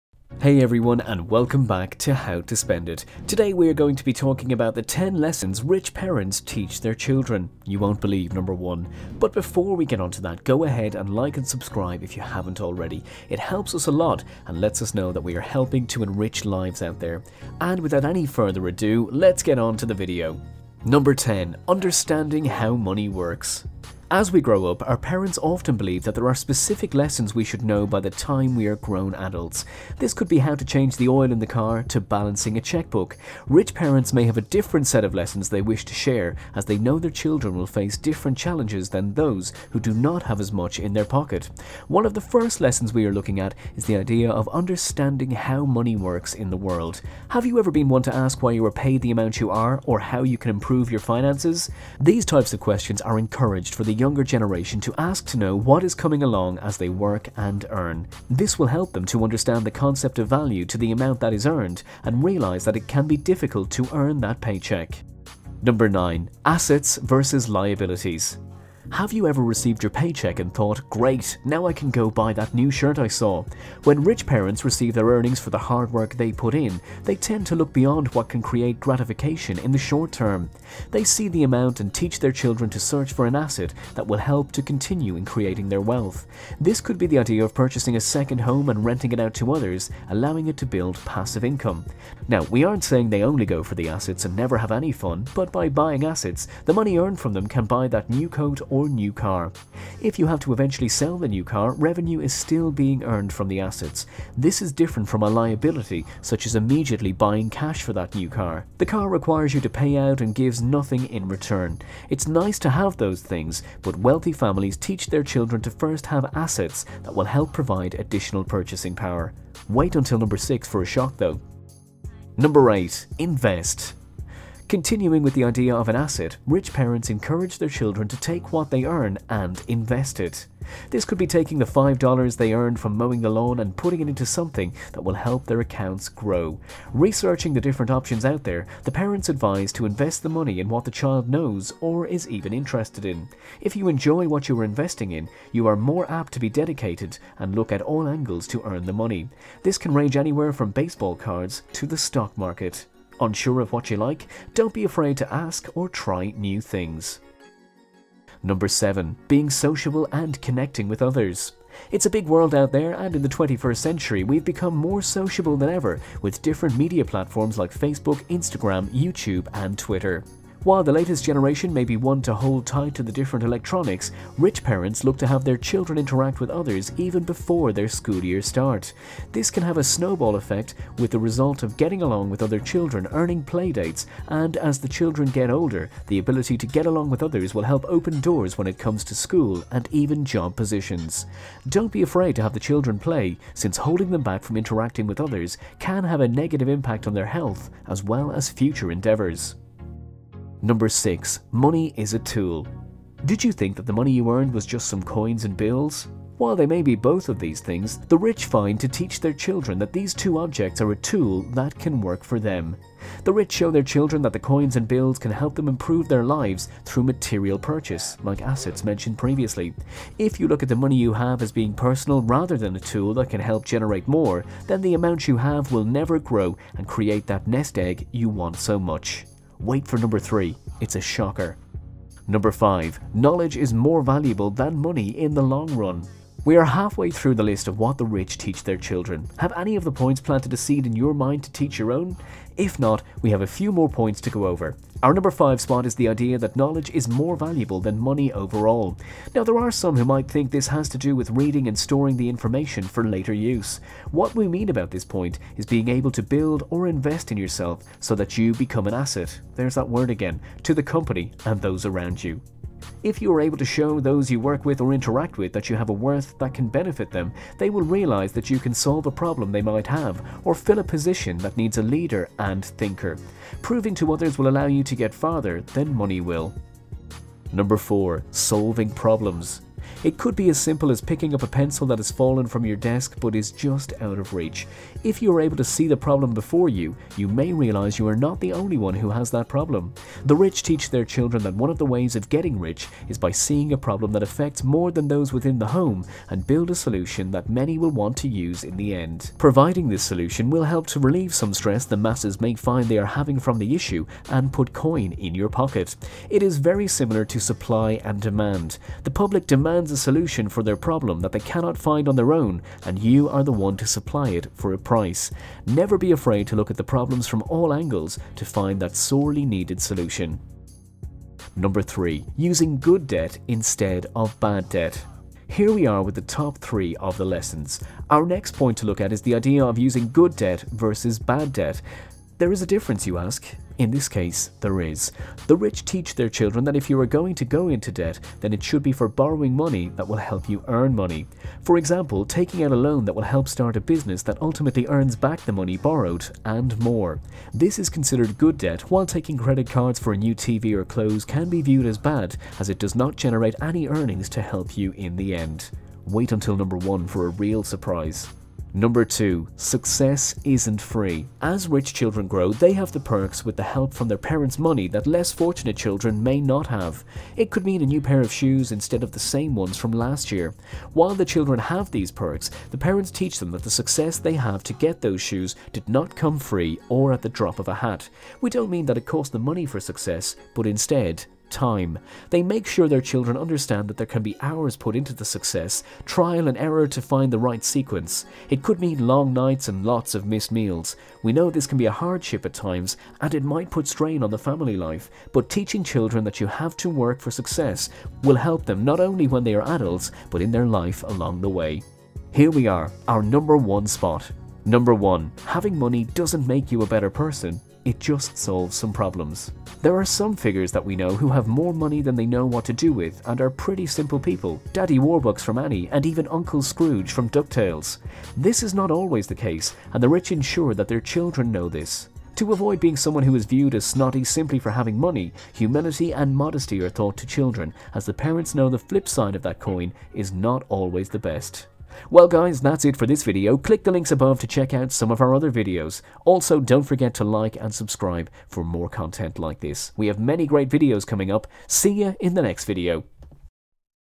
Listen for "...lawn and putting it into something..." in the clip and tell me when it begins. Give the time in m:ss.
2:13.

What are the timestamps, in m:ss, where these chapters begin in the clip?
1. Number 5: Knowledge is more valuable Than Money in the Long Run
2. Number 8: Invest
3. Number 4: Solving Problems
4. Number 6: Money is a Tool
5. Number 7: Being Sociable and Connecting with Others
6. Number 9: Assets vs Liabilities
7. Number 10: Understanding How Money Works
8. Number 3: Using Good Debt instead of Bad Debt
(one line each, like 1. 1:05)
1. 3:54
2. 2:02
3. 4:38
4. 3:21
5. 2:39
6. 1:06
7. 0:21
8. 5:22.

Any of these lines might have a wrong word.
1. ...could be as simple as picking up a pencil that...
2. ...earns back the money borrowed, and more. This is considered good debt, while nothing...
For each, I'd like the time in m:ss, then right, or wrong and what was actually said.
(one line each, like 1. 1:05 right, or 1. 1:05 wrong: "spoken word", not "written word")
1. 4:40 right
2. 5:44 wrong: "taking", not "nothing".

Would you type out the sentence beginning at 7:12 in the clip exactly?
Well guys, that's it for this video.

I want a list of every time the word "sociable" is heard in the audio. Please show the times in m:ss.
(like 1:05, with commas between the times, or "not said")
2:39, 2:45.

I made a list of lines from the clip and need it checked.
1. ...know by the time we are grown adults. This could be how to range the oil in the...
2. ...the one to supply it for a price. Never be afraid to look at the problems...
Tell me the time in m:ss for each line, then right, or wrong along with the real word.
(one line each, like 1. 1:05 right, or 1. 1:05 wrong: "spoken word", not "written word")
1. 0:27 wrong: "change", not "range"
2. 5:13 right.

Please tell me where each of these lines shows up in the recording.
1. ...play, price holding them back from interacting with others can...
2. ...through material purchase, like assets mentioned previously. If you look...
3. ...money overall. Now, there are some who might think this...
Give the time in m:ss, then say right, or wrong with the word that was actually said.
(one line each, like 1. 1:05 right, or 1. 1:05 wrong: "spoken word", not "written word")
1. 3:12 wrong: "since", not "price"
2. 3:36 right
3. 4:07 right.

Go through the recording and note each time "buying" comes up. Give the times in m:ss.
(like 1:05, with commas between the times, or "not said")
1:35, 1:47.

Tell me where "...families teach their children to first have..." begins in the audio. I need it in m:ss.
1:54.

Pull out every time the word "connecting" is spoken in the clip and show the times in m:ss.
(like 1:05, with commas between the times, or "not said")
2:40.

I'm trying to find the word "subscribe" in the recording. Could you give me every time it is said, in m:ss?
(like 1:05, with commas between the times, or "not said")
0:11, 7:17.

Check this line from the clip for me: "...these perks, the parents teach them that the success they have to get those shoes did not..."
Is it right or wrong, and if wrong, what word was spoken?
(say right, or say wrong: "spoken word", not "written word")
right.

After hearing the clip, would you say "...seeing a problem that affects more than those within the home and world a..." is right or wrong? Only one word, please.
wrong.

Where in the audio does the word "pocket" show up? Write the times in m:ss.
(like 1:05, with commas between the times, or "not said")
0:41, 5:05.